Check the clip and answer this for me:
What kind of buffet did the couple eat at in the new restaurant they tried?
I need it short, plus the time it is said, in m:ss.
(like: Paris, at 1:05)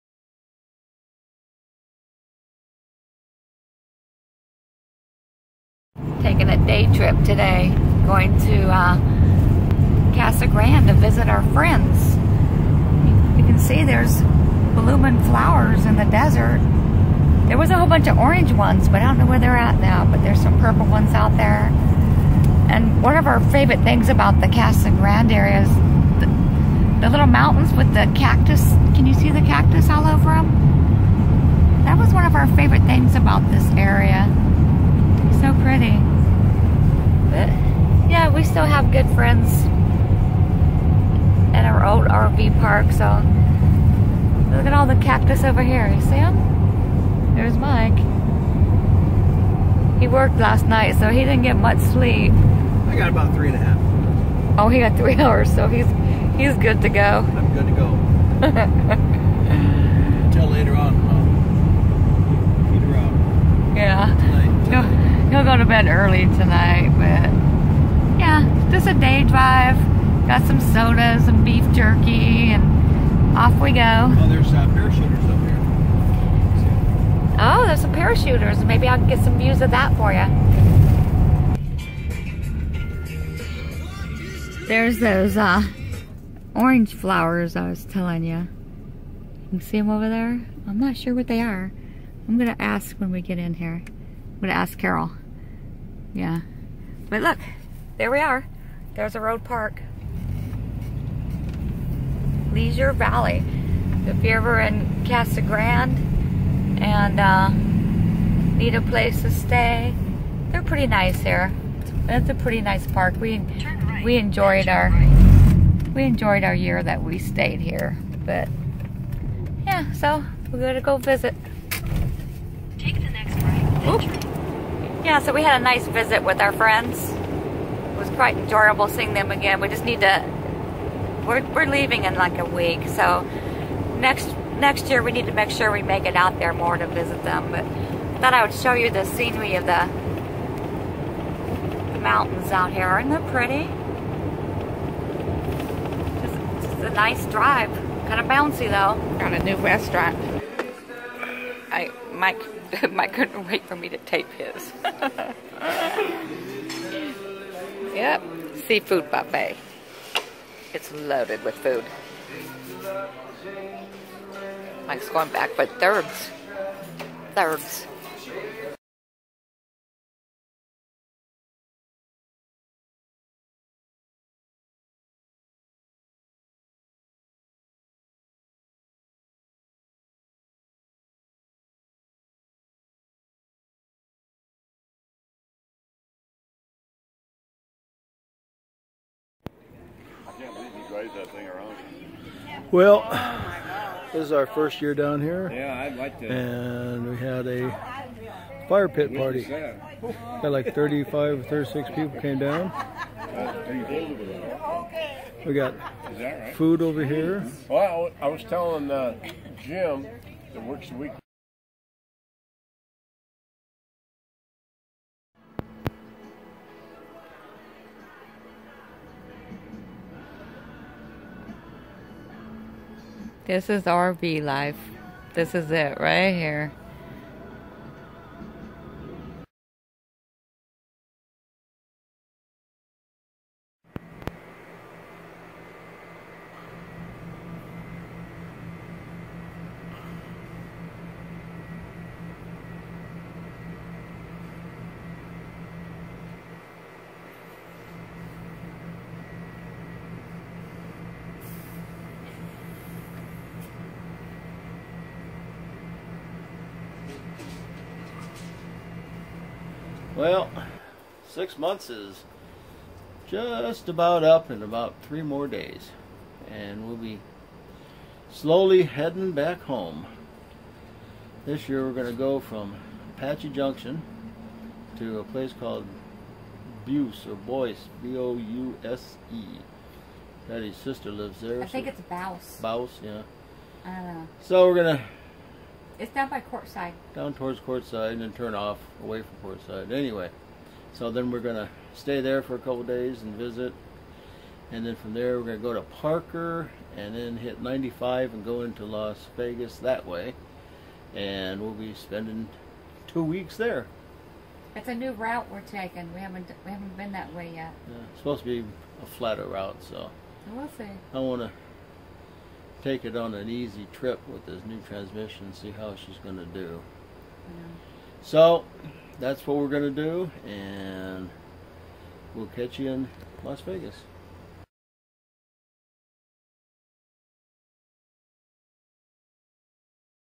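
Seafood buffet, at 2:38.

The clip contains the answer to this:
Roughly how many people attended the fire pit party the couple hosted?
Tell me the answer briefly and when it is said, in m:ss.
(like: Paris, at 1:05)
35 or 36, at 3:20.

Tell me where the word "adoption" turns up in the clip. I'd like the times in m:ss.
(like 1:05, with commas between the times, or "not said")
not said.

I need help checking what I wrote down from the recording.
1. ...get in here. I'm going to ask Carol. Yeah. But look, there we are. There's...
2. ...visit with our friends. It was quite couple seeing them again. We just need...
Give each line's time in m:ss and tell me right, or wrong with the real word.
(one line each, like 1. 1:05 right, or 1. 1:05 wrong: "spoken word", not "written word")
1. 1:33 right
2. 2:05 wrong: "enjoyable", not "couple".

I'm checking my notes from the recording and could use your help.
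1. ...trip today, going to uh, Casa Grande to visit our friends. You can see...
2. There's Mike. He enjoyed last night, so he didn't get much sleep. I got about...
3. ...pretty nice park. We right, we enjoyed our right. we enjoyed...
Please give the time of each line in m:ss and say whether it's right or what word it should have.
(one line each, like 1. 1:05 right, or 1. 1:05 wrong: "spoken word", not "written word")
1. 0:06 right
2. 0:47 wrong: "worked", not "enjoyed"
3. 1:52 right.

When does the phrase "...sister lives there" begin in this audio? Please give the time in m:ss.
4:40.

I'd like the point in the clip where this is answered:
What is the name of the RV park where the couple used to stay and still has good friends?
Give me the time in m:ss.
1:42.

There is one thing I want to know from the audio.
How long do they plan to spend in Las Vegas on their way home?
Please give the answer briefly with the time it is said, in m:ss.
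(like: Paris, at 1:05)
Two weeks, at 5:03.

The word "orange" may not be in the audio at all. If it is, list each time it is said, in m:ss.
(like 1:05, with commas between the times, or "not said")
0:18, 1:26.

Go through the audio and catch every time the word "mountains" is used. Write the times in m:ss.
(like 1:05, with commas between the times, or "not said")
0:27, 2:21.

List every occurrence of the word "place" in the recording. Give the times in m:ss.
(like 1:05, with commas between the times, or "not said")
1:48, 4:35.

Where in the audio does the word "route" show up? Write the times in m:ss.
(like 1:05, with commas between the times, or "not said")
5:05, 5:09.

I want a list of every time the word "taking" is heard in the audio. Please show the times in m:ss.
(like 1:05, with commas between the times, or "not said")
0:06, 5:05.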